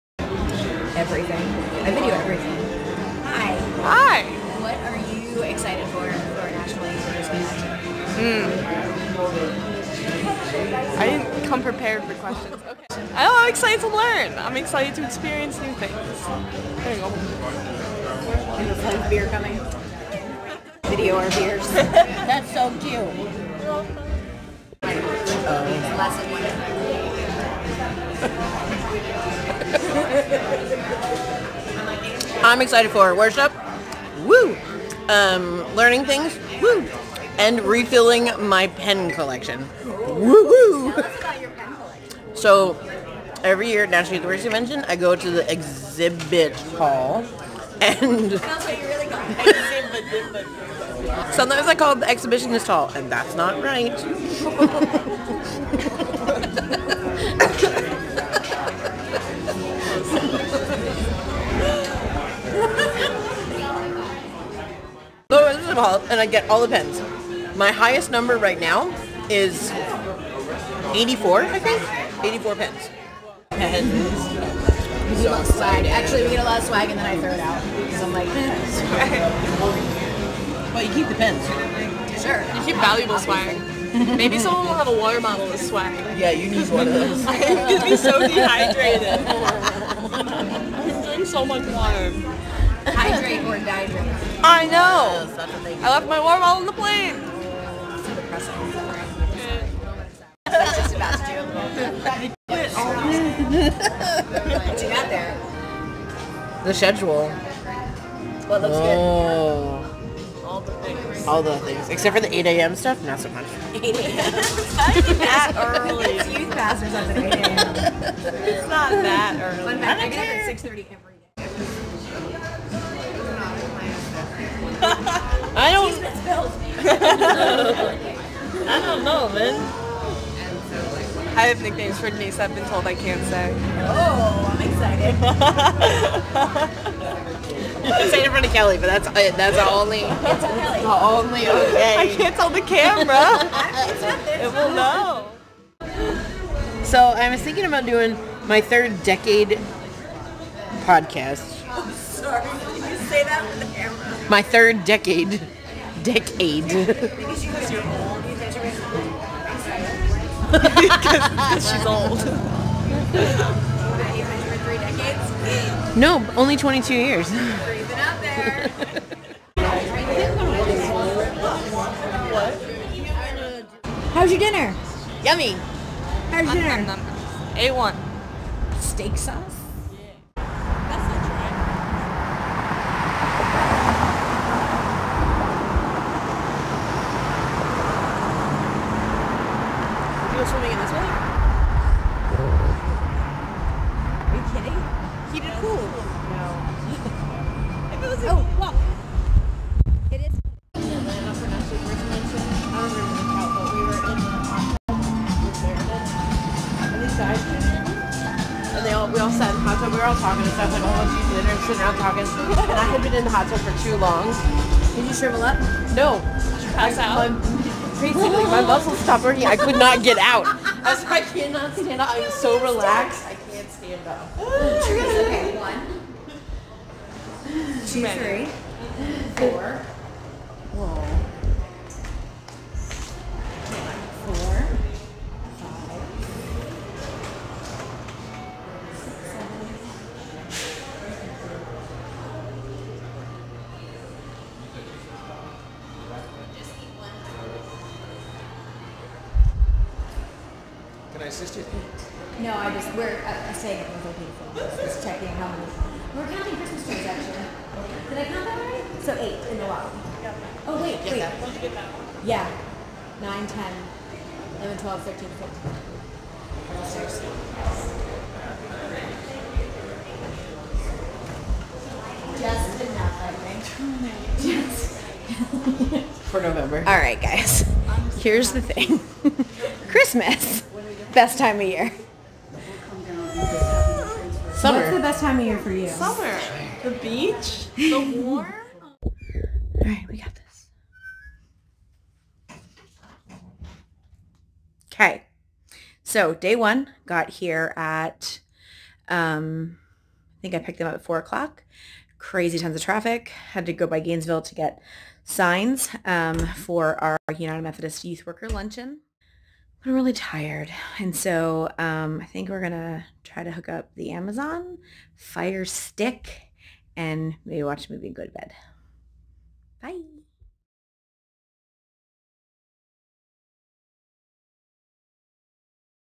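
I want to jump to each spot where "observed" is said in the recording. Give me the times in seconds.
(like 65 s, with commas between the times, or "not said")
not said.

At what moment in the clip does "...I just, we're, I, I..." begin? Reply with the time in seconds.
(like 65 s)
252 s.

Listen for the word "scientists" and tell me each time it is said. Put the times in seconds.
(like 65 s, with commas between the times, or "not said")
not said.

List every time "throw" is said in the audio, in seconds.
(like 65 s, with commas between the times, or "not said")
77 s.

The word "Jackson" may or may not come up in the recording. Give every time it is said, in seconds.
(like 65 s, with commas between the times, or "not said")
not said.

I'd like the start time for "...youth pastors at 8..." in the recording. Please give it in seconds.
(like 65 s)
116 s.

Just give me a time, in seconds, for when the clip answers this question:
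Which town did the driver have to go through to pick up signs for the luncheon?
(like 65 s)
303 s.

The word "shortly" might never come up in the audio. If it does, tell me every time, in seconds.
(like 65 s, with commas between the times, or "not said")
not said.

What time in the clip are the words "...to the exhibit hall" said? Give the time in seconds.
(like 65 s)
45 s.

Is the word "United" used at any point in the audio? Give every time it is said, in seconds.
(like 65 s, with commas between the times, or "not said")
307 s.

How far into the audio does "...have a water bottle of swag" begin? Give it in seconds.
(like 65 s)
84 s.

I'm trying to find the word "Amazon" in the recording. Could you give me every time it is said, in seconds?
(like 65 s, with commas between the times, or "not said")
314 s.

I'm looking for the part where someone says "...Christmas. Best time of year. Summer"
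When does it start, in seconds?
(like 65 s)
279 s.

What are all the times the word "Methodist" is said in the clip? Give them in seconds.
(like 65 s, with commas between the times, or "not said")
307 s.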